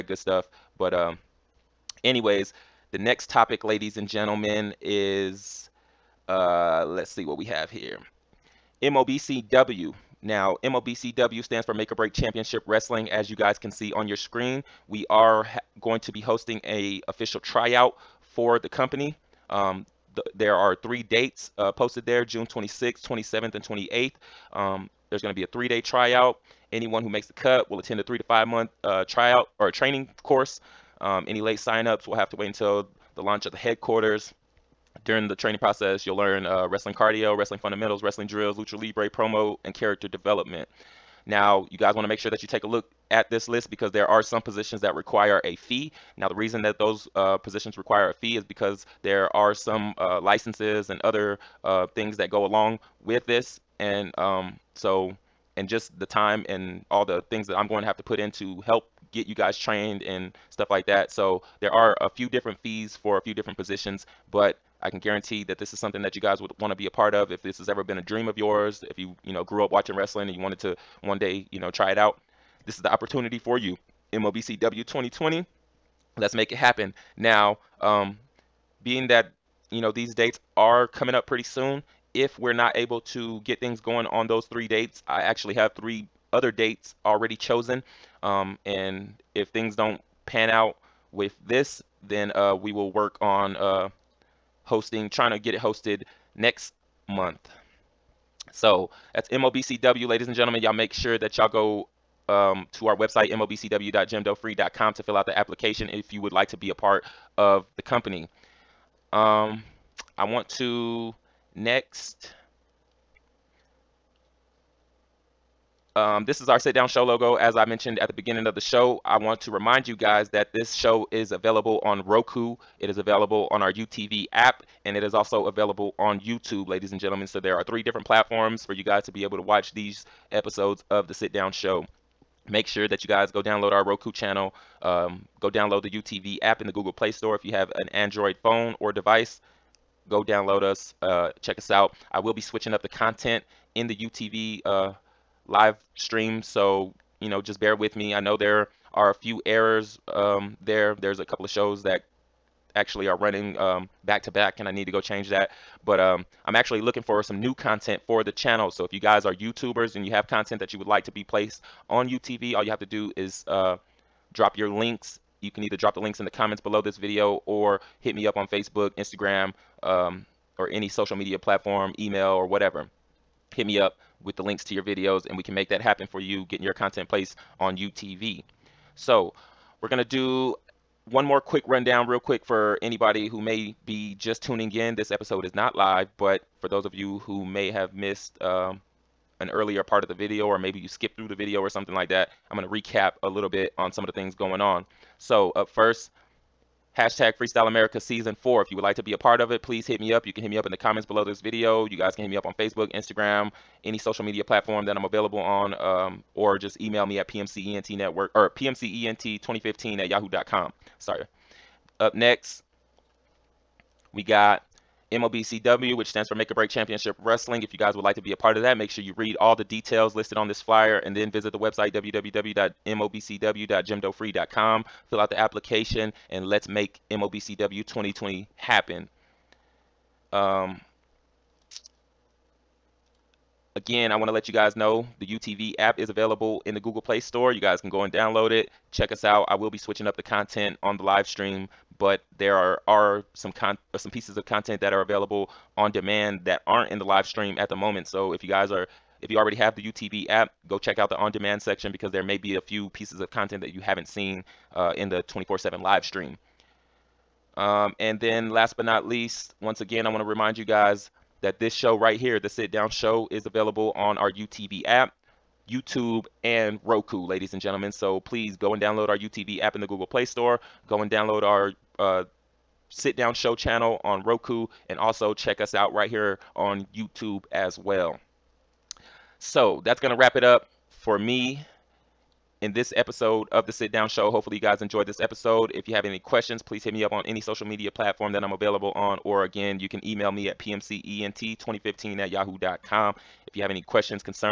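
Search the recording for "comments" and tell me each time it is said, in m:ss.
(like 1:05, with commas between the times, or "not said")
2:46, 3:20.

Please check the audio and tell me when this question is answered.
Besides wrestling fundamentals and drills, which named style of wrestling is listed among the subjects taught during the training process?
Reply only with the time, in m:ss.
0:38.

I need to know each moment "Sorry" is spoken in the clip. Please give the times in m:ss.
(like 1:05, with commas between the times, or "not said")
3:30.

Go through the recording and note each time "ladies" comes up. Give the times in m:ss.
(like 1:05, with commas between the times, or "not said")
0:03, 1:40, 2:06, 4:27.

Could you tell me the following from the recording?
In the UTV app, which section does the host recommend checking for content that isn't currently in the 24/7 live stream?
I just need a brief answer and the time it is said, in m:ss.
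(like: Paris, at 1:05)
On demand section, at 4:11.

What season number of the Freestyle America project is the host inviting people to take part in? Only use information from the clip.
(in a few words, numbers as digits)
Season 4.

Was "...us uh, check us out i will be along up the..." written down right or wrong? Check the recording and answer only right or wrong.
wrong.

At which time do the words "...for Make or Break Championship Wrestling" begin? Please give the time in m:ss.
0:11.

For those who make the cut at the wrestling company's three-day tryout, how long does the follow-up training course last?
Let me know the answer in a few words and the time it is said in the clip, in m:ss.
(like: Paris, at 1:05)
3 to 5 months, at 0:28.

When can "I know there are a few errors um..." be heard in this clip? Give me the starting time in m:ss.
2:28.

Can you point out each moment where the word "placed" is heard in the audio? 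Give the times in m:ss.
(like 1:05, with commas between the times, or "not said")
2:41, 2:57.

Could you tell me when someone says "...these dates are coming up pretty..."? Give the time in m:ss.
1:19.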